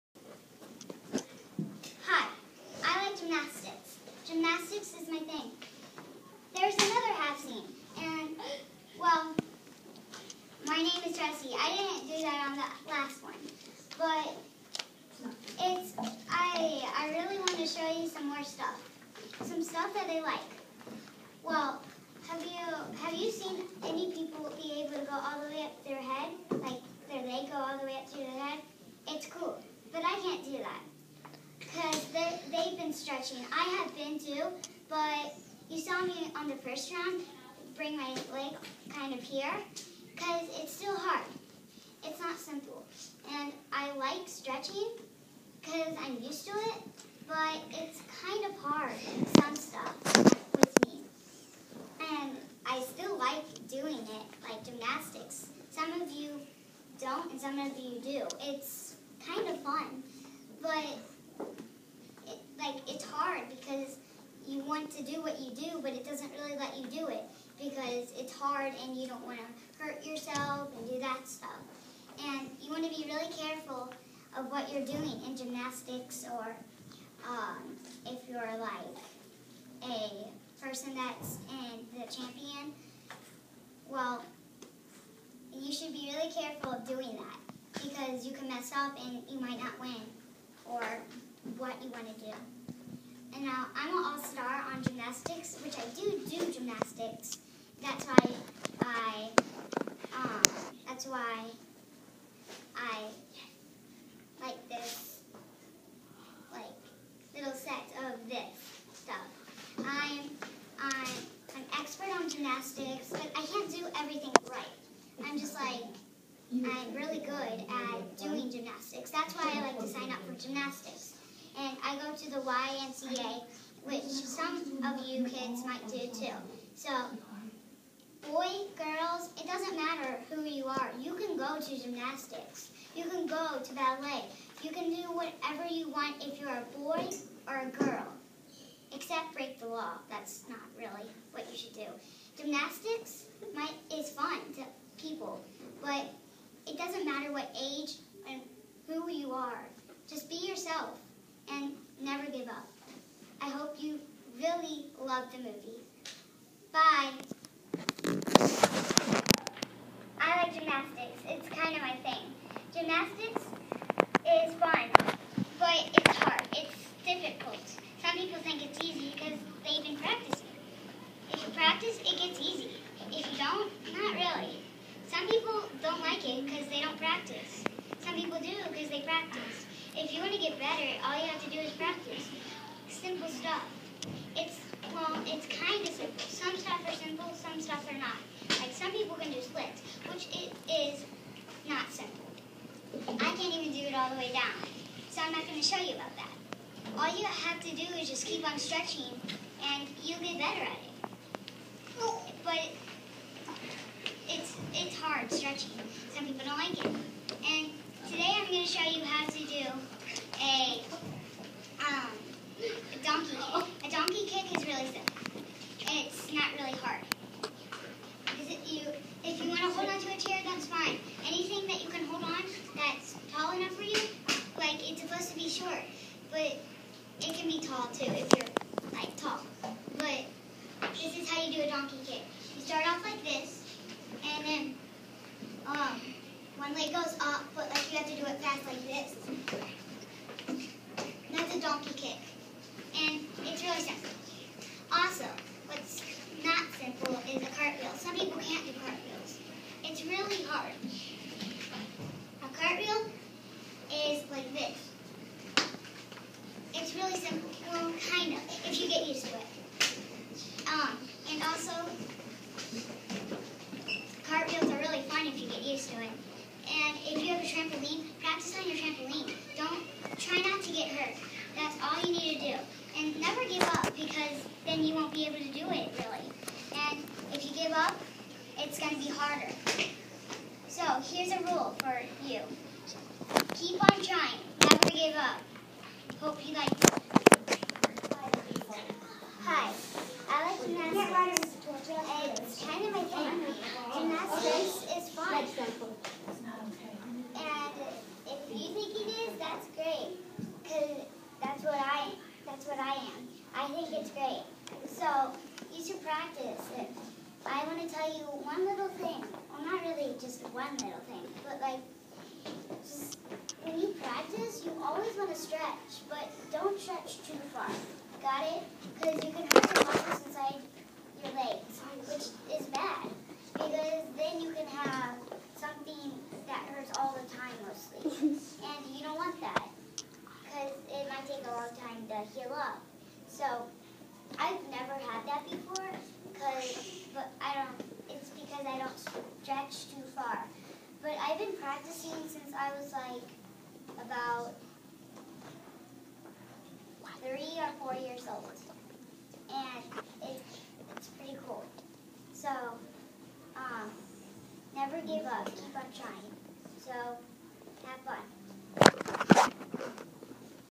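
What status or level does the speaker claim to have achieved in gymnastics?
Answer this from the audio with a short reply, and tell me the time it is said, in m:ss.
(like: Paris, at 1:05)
All-star, at 1:34.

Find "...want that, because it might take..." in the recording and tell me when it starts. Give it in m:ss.
5:29.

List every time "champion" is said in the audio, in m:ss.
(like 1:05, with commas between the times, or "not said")
1:22.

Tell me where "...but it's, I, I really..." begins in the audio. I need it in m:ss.
0:13.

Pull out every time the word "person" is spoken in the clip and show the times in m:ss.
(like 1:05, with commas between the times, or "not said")
1:20.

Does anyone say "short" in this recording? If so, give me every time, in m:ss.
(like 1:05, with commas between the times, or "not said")
3:45.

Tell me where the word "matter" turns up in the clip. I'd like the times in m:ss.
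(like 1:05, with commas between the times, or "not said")
2:09, 2:27.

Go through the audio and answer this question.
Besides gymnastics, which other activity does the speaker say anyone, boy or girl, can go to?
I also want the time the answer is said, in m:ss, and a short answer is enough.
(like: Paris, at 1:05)
Ballet, at 2:13.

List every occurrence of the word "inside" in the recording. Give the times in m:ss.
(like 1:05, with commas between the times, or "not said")
5:20.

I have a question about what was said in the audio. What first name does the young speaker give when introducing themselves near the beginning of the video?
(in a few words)
Jesse.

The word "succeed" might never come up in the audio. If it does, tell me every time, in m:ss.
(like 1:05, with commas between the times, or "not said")
not said.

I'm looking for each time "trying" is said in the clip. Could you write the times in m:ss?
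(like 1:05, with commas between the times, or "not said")
4:44, 5:55.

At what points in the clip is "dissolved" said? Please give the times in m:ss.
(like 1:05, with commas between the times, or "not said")
not said.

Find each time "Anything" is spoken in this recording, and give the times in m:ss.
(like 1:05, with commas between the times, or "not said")
3:41.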